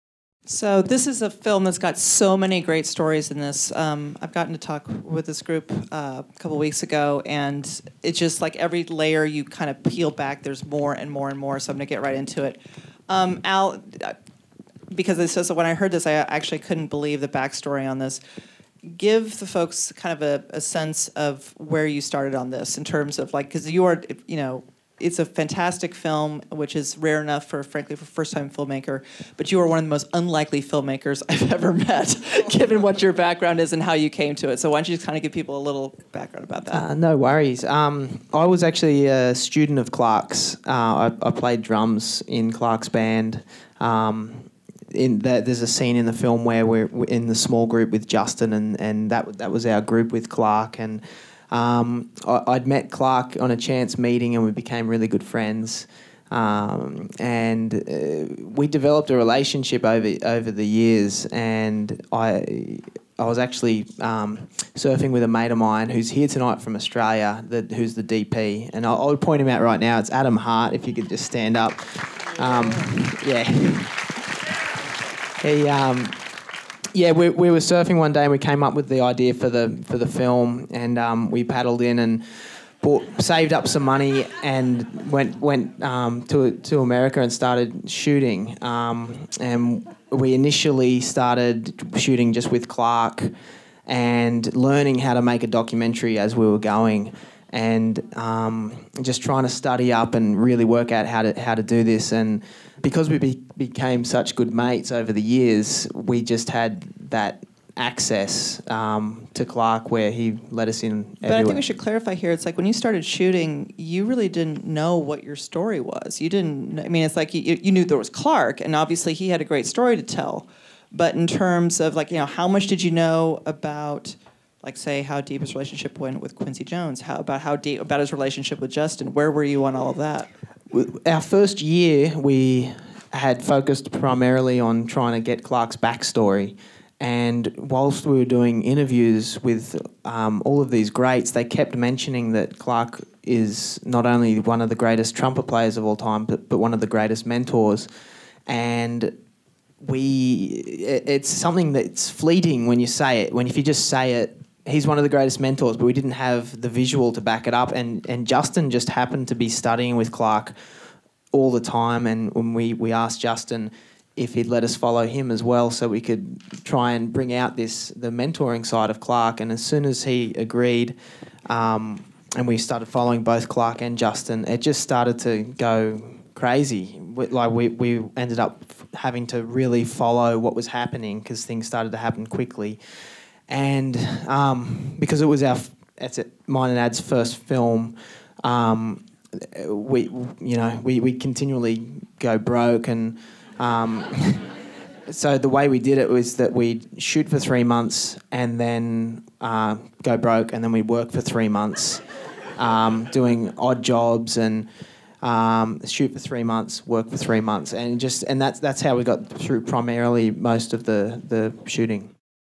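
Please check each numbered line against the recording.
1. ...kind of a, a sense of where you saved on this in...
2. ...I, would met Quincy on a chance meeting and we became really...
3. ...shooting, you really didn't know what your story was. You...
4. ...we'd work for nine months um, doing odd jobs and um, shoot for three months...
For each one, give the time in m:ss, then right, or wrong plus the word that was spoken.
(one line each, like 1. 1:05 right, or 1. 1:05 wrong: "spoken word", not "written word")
1. 0:19 wrong: "started", not "saved"
2. 0:52 wrong: "Clark", not "Quincy"
3. 1:53 right
4. 3:20 wrong: "three", not "nine".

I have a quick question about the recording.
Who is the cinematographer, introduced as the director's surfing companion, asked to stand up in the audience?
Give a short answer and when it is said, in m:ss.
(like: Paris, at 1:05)
Adam Hart, at 1:10.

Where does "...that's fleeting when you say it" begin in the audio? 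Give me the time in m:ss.
2:31.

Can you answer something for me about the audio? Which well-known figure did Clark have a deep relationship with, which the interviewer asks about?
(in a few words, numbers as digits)
Quincy Jones.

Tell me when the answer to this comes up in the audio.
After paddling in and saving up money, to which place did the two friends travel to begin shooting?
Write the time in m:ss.
1:26.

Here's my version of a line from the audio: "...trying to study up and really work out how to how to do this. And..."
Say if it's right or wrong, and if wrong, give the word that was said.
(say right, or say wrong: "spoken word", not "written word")
right.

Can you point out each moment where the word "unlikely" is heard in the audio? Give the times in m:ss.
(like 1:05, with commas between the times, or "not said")
0:30.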